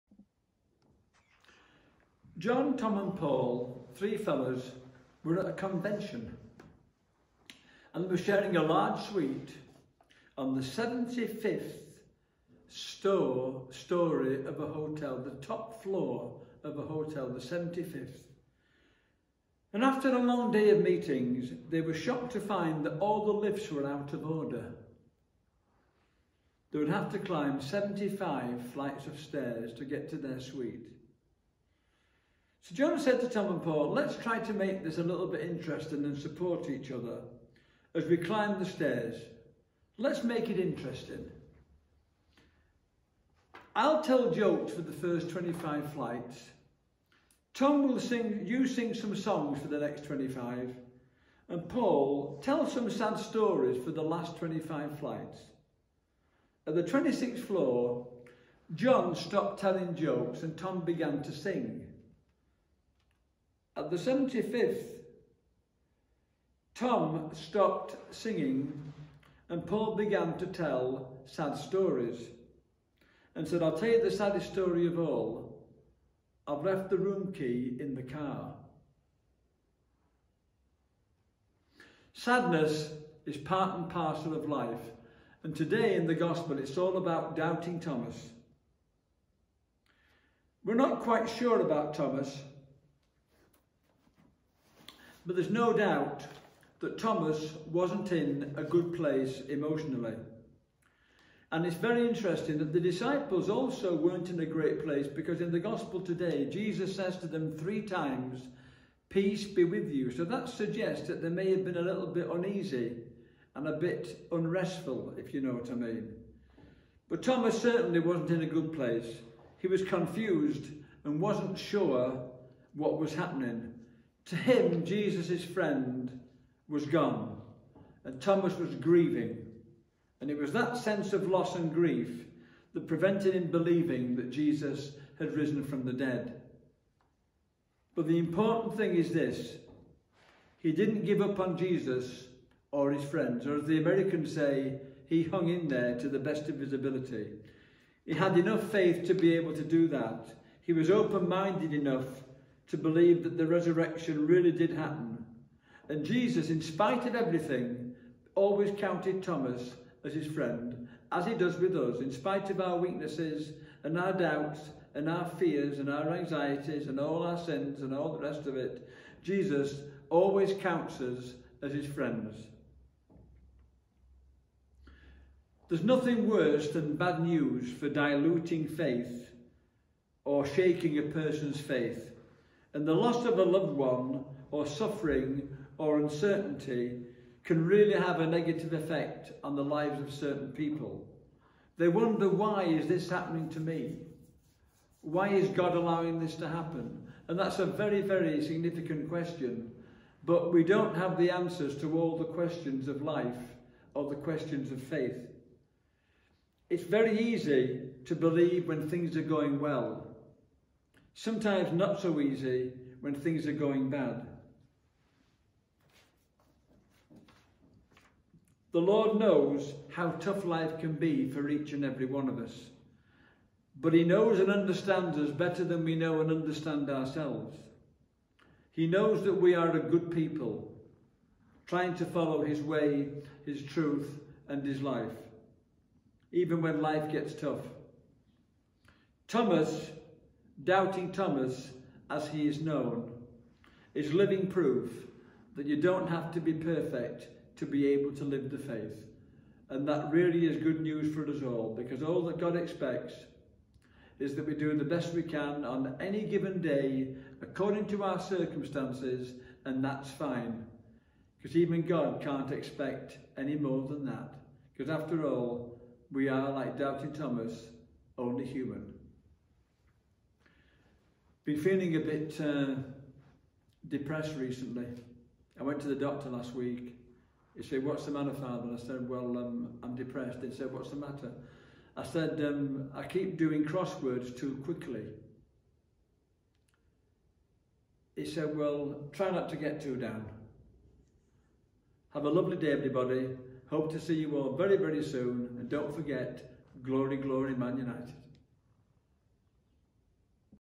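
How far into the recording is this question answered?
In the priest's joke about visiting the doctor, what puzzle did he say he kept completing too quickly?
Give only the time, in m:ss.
4:43.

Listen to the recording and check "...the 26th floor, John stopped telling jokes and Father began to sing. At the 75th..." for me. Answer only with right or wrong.
wrong.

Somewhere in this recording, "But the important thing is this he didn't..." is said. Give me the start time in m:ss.
2:17.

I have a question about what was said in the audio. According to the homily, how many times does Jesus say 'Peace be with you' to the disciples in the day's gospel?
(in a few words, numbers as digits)
3.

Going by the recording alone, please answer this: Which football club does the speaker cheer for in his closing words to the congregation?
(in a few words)
Man United.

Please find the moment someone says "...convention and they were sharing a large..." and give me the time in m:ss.
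0:05.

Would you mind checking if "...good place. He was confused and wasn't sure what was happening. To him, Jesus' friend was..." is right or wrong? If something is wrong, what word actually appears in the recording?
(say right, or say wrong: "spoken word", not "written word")
right.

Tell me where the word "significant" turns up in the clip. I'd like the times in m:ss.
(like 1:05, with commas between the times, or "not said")
3:18.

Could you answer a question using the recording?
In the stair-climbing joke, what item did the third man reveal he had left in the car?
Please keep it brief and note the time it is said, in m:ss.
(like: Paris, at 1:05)
the room key, at 1:16.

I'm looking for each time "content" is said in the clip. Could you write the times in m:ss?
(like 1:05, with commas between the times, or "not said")
not said.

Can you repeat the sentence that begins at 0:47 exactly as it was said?
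Tom will sing, you sing some songs for the next 25.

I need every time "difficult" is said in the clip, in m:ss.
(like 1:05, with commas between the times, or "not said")
not said.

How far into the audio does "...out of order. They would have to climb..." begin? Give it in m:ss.
0:23.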